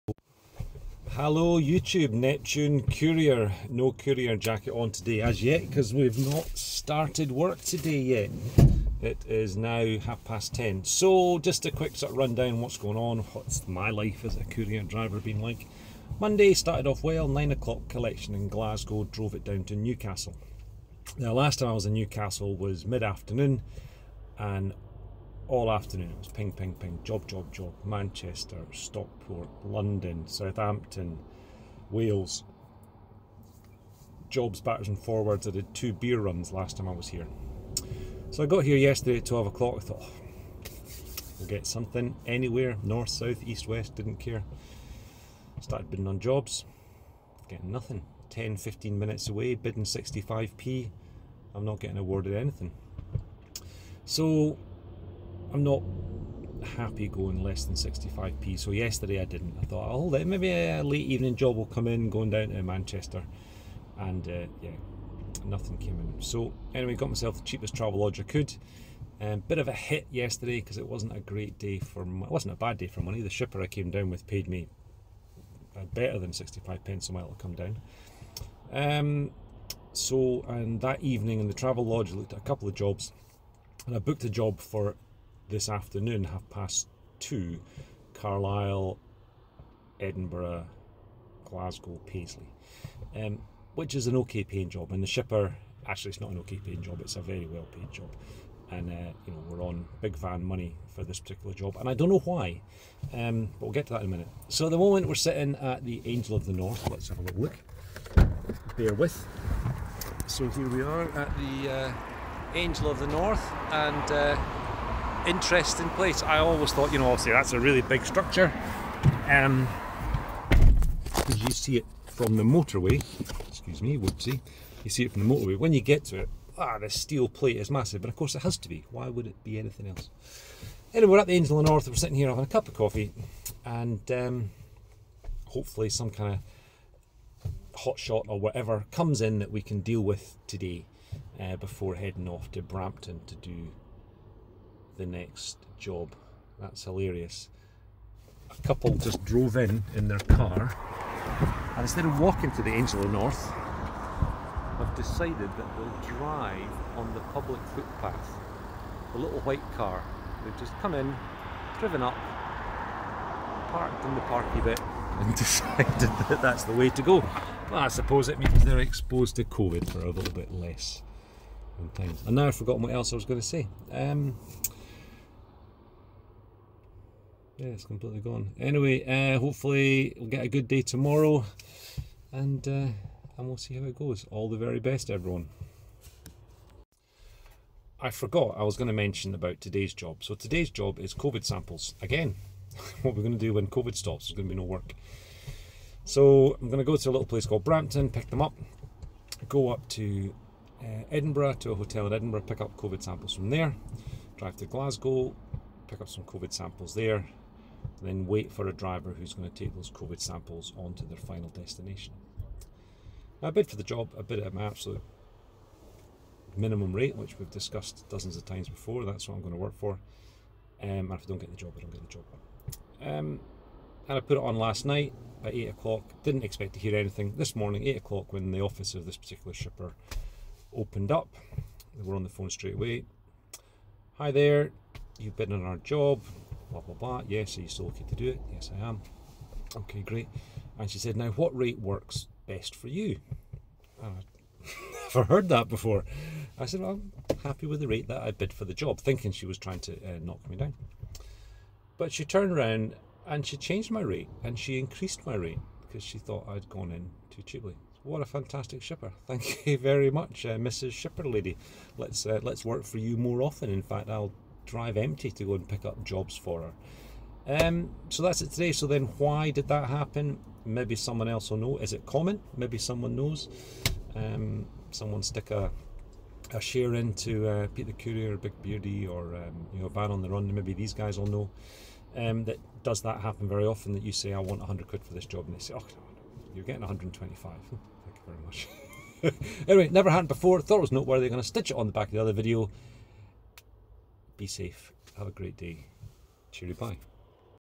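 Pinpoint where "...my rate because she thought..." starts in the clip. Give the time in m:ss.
4:15.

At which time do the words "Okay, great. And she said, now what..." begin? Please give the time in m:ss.
3:59.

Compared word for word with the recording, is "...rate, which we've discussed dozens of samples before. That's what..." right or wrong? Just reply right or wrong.
wrong.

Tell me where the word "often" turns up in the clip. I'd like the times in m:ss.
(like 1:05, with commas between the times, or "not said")
4:23, 4:43.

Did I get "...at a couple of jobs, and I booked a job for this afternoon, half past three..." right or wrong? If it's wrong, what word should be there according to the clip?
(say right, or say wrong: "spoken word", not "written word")
wrong: "two", not "three".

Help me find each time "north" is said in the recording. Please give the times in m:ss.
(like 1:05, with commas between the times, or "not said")
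0:42, 1:46, 1:53, 2:11, 2:33.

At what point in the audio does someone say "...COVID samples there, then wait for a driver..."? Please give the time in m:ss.
3:26.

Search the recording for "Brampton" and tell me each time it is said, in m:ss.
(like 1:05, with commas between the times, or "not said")
2:22, 3:17.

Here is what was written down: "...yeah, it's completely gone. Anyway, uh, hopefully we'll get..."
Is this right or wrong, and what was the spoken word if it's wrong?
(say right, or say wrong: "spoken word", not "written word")
right.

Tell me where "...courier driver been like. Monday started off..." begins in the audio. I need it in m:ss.
0:14.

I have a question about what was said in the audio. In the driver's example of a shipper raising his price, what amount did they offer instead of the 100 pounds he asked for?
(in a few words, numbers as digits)
125.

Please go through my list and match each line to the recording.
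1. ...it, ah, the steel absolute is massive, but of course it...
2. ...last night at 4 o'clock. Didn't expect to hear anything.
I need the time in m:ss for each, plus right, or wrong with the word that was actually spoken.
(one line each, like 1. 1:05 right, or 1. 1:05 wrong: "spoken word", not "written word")
1. 2:06 wrong: "plate", not "absolute"
2. 3:44 wrong: "8", not "4".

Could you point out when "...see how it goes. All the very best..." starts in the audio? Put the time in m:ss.
3:03.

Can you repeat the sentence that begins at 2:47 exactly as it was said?
Well, I suppose it means they're exposed to COVID for a little bit less.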